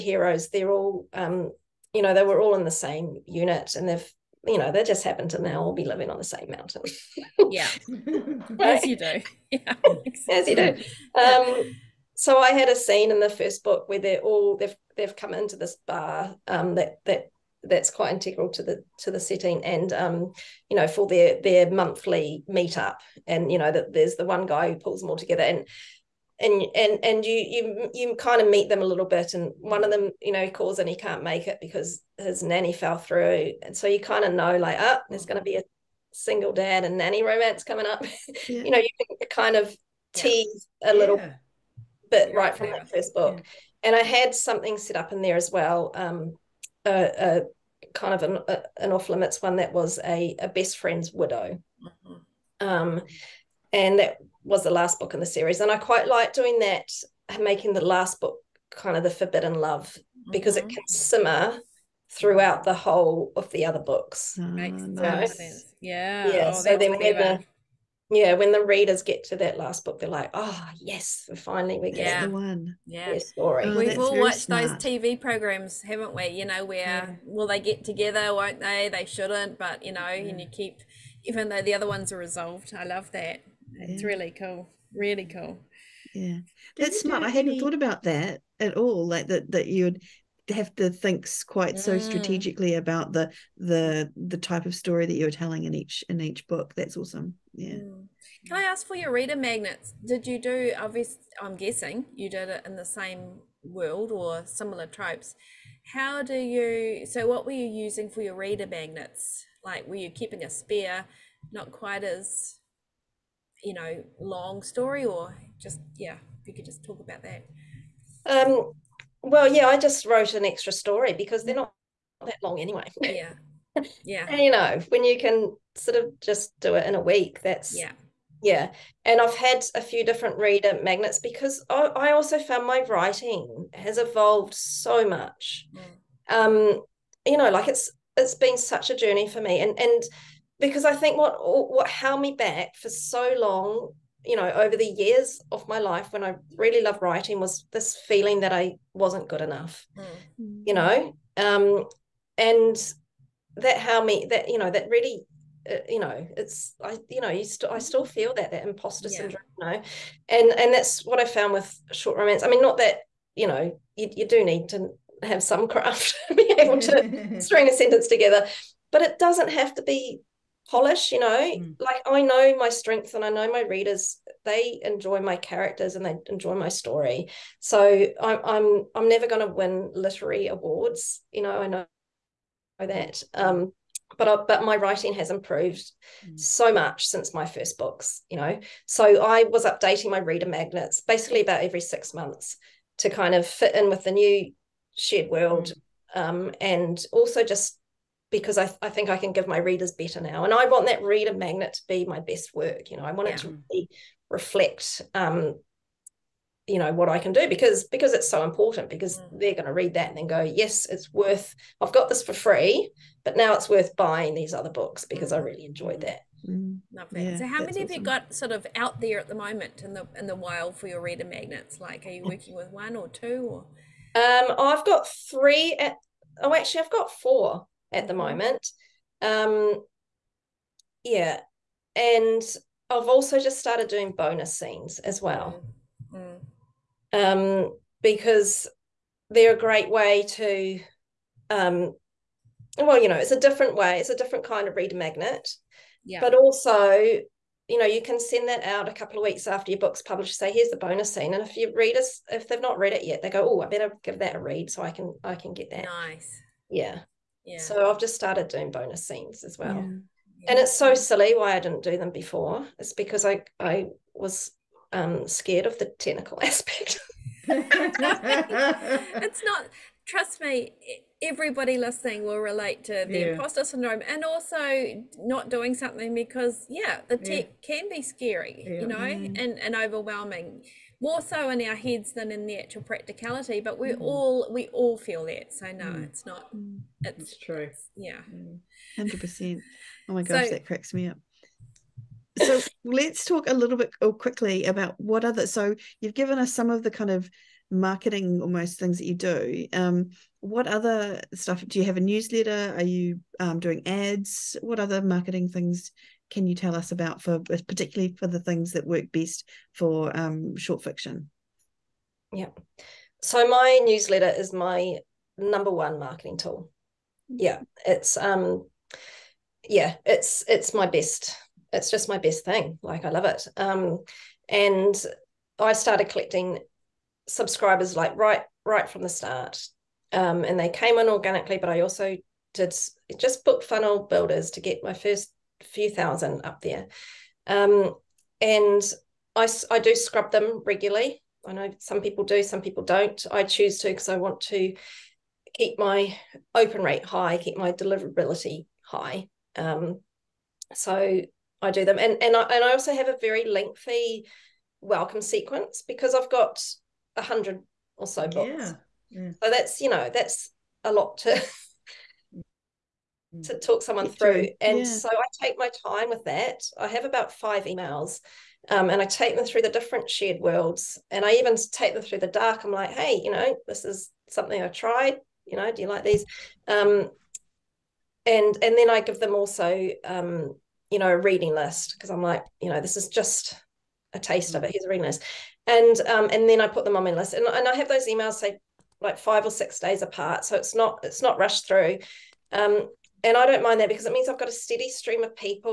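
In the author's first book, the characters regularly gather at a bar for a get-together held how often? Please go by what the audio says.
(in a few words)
Monthly.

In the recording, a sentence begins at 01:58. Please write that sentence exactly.
Um, well, yeah, I just wrote an extra story because they're not that long anyway.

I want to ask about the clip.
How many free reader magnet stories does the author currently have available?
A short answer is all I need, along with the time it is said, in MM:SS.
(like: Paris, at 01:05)
4, at 03:47.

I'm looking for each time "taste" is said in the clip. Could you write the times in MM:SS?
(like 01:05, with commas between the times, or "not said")
06:24.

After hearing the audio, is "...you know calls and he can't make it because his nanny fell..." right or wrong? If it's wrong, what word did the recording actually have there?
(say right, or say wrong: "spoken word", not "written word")
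right.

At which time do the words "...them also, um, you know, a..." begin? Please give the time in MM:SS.
06:19.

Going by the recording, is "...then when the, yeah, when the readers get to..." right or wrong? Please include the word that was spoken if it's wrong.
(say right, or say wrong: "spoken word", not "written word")
right.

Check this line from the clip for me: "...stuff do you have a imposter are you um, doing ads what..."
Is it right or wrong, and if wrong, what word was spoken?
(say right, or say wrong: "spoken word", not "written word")
wrong: "newsletter", not "imposter".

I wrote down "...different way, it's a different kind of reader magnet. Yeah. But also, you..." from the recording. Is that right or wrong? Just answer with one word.
right.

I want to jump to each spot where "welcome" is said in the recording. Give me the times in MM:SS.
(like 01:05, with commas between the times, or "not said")
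05:54.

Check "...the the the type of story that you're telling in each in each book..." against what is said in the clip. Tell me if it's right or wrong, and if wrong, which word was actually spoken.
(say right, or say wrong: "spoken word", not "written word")
right.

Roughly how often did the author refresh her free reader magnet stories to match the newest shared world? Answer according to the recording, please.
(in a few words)
Every 6 months.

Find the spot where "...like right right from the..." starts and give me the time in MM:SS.
05:27.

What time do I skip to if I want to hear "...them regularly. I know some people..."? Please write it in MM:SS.
05:40.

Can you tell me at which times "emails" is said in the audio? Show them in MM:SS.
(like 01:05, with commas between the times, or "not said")
06:07, 06:28.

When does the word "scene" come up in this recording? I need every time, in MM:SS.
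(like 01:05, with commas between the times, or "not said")
00:12, 03:54, 04:11, 04:19.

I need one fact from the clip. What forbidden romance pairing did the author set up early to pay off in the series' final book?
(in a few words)
Best friend's widow.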